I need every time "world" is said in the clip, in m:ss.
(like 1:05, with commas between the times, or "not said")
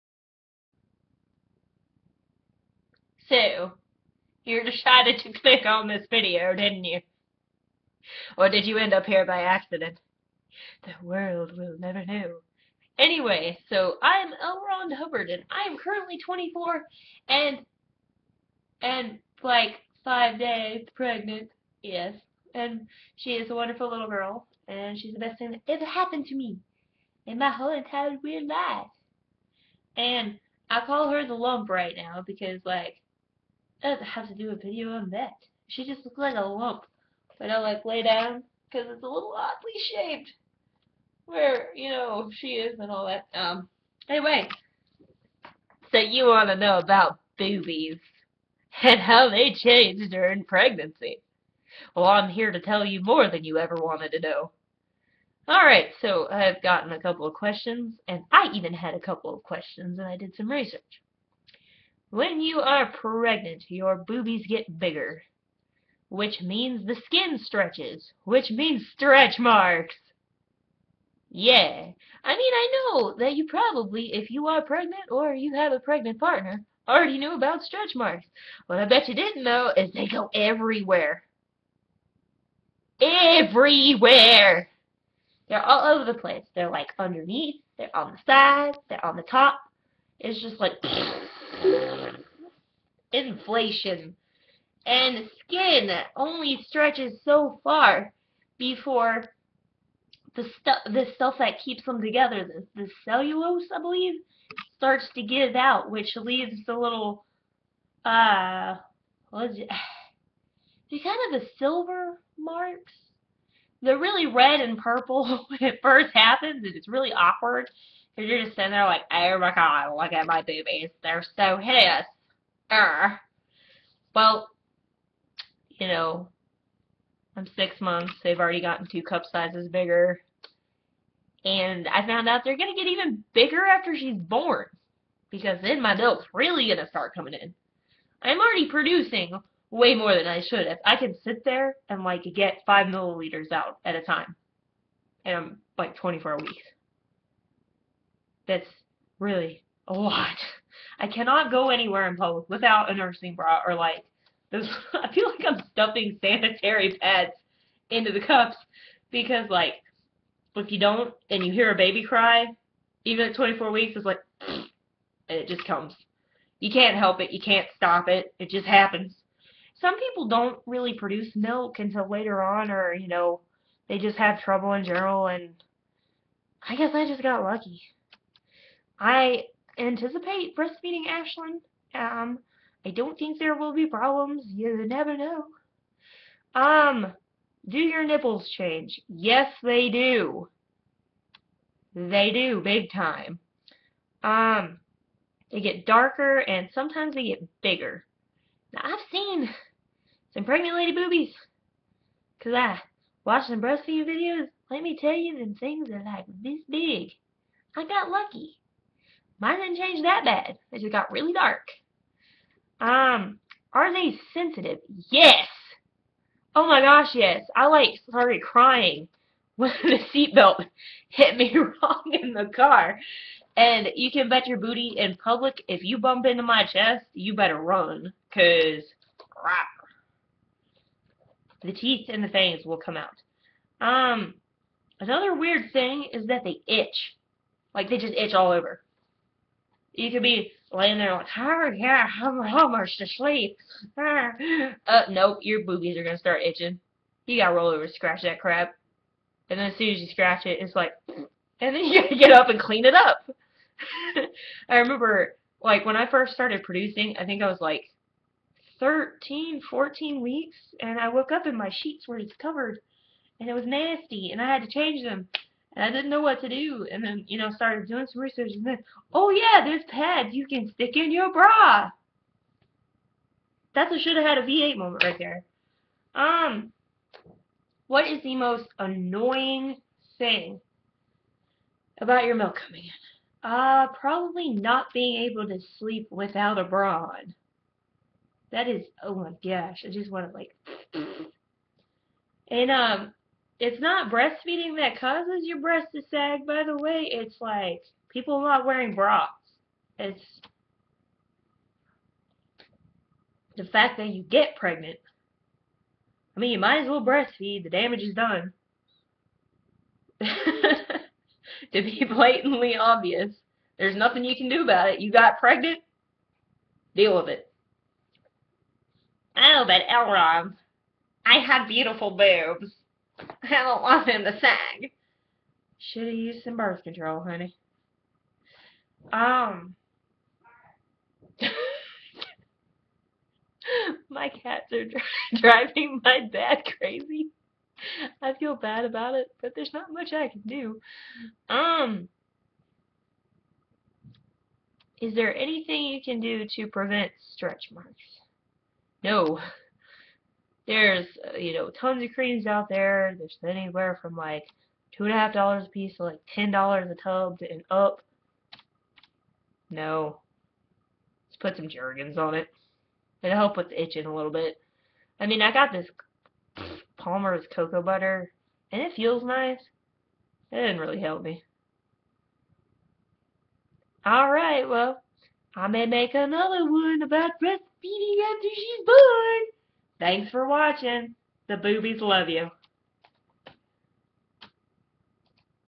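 0:11.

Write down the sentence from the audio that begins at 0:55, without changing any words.
Alright, so I've gotten a couple of questions, and I even had a couple of questions, and I did some research.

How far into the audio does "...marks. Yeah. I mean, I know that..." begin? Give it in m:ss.
1:09.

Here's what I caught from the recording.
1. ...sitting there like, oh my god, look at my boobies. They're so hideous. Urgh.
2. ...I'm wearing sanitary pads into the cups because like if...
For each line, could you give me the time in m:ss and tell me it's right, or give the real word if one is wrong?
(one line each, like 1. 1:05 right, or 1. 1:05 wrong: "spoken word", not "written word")
1. 1:58 right
2. 2:35 wrong: "stuffing", not "wearing".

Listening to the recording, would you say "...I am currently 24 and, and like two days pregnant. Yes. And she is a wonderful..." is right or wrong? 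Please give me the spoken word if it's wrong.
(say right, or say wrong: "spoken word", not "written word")
wrong: "five", not "two".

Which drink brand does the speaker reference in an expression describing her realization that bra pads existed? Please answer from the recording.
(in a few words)
V8.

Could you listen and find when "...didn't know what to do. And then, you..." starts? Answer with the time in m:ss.
4:25.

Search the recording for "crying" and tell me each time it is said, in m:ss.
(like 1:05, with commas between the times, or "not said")
3:38.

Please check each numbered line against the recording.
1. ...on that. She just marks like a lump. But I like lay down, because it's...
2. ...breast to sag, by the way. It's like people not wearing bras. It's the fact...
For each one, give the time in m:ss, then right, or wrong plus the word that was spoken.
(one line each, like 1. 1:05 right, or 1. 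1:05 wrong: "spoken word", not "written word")
1. 0:34 wrong: "looks", not "marks"
2. 4:55 right.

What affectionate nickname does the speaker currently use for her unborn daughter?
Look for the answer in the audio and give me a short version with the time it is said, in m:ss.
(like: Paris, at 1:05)
the lump, at 0:31.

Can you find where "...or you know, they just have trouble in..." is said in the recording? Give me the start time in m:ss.
2:52.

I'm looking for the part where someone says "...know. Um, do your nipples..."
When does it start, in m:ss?
3:05.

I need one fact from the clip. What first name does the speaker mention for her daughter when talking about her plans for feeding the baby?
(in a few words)
Ashlyn.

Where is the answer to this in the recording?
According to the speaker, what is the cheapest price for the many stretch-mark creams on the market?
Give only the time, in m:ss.
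5:54.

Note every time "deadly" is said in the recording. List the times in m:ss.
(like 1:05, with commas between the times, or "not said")
not said.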